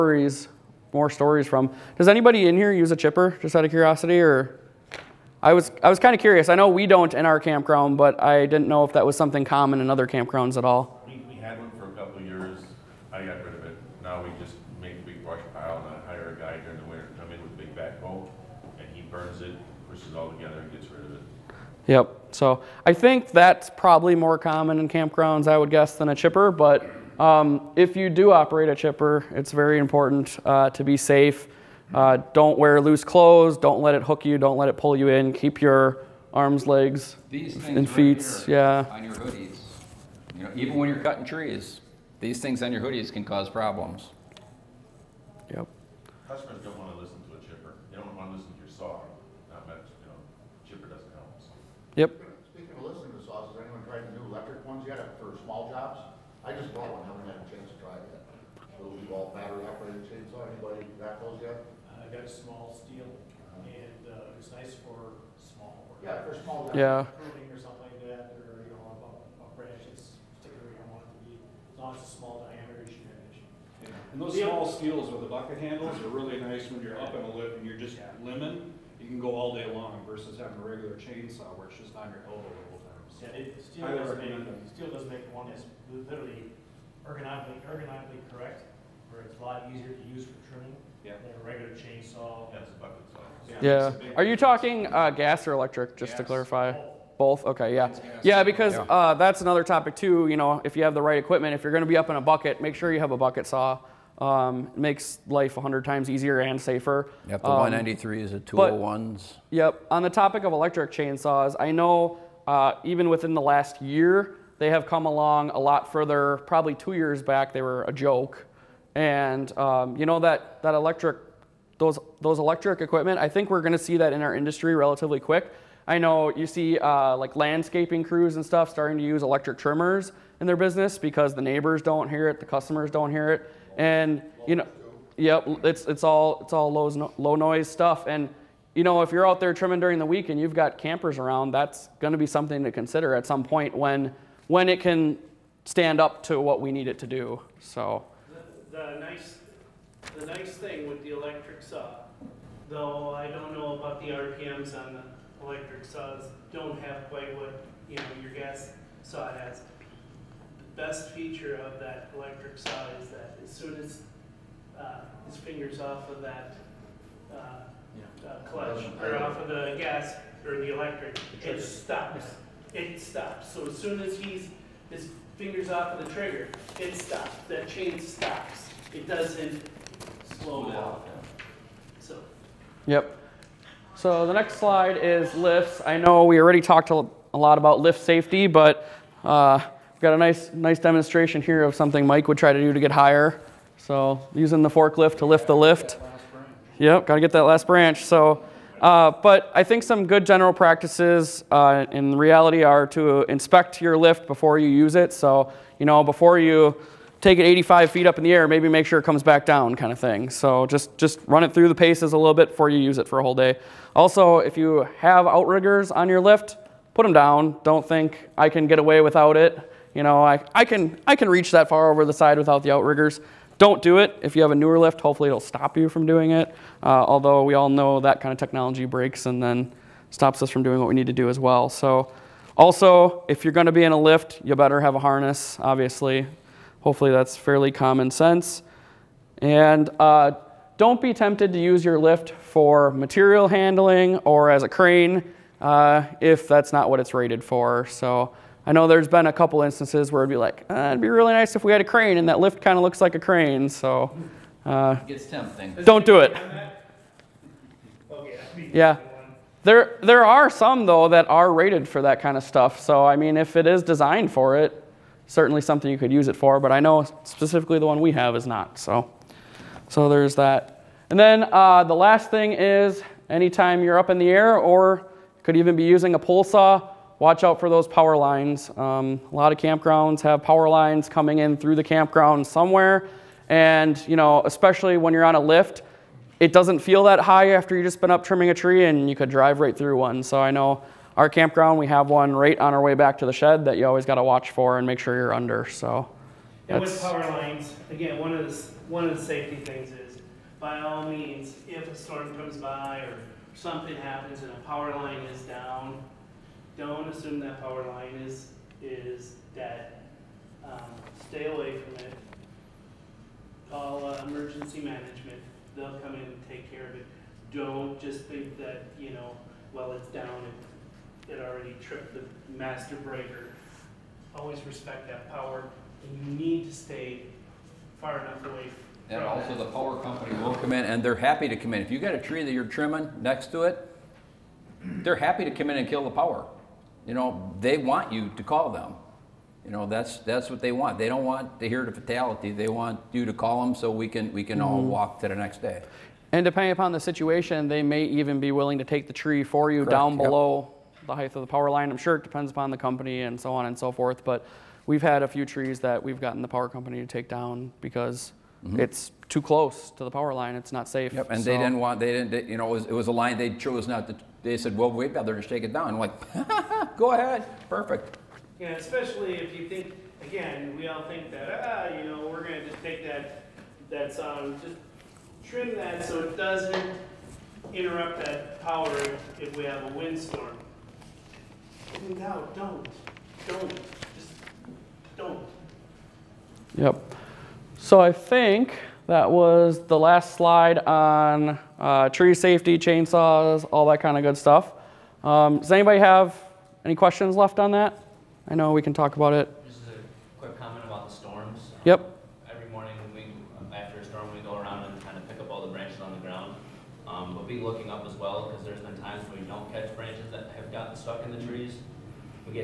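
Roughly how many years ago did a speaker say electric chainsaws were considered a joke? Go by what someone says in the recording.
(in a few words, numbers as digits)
2.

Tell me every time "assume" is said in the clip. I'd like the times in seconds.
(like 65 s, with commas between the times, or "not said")
307 s.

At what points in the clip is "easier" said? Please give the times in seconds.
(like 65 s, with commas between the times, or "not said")
89 s, 106 s.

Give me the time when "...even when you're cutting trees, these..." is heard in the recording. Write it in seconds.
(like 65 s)
40 s.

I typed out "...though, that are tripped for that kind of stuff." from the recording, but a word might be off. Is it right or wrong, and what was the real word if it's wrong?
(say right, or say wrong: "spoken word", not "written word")
wrong: "rated", not "tripped".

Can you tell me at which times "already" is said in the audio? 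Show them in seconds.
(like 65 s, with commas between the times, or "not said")
186 s, 321 s.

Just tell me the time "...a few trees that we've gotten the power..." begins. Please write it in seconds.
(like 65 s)
355 s.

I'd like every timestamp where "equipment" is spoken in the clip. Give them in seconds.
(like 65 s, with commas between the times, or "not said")
101 s, 122 s.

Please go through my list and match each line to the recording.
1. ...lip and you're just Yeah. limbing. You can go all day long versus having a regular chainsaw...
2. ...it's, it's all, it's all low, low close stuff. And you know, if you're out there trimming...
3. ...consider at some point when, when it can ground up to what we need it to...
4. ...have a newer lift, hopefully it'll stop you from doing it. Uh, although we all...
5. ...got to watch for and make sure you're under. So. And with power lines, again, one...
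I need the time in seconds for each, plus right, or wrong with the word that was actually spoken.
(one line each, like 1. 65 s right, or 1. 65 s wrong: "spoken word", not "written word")
1. 77 s right
2. 135 s wrong: "noise", not "close"
3. 142 s wrong: "stand", not "ground"
4. 224 s right
5. 294 s right.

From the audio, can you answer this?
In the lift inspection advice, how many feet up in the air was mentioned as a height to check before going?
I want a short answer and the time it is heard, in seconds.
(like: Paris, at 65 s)
85, at 207 s.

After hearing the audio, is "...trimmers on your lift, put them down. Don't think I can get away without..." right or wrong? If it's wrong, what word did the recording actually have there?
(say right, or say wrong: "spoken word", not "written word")
wrong: "outriggers", not "trimmers".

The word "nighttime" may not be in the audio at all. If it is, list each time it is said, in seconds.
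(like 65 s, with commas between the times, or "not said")
not said.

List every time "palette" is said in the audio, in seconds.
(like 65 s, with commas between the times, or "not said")
not said.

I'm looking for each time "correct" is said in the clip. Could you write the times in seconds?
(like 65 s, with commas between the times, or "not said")
88 s, 349 s.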